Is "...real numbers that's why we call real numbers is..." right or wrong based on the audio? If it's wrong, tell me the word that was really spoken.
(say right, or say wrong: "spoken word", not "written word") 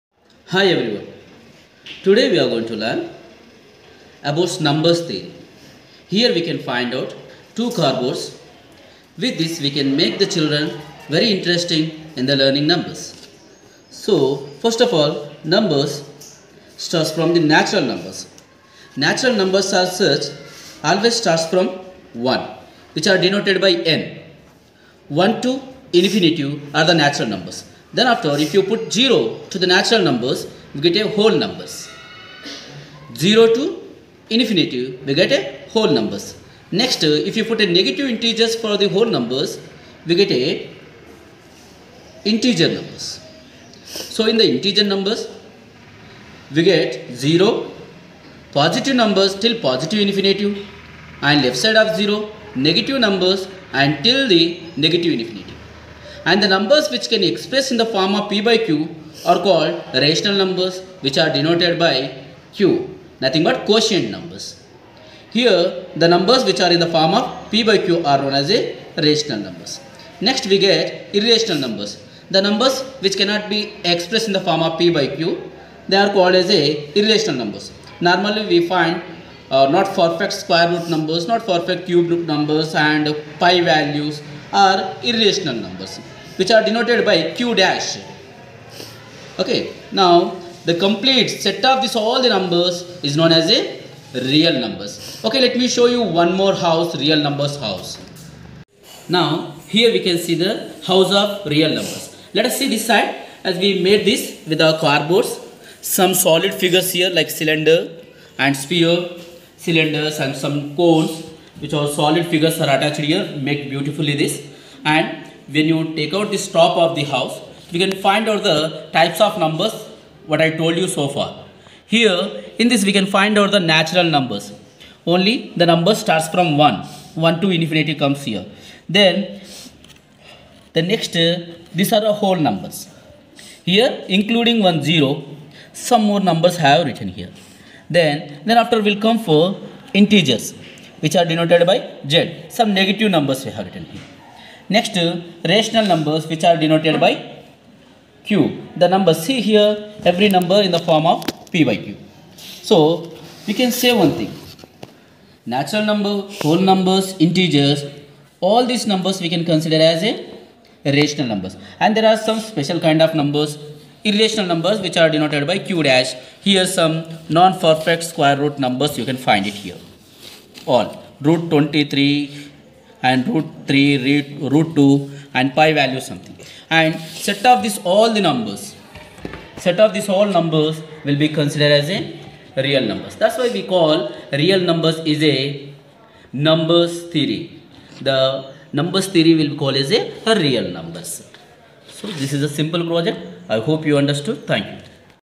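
right.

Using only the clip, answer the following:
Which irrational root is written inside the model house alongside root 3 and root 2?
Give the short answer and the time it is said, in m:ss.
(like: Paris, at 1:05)
root 23, at 2:51.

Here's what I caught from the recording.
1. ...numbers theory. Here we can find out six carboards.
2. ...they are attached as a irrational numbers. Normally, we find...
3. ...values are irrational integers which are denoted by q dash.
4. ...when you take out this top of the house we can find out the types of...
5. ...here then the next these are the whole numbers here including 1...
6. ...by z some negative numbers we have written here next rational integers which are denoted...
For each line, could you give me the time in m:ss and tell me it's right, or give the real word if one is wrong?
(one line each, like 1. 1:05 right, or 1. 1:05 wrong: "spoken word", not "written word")
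1. 0:04 wrong: "two", not "six"
2. 1:15 wrong: "called", not "attached"
3. 1:23 wrong: "numbers", not "integers"
4. 1:55 right
5. 2:08 right
6. 2:21 wrong: "numbers", not "integers".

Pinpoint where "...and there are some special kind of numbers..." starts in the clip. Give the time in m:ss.
2:41.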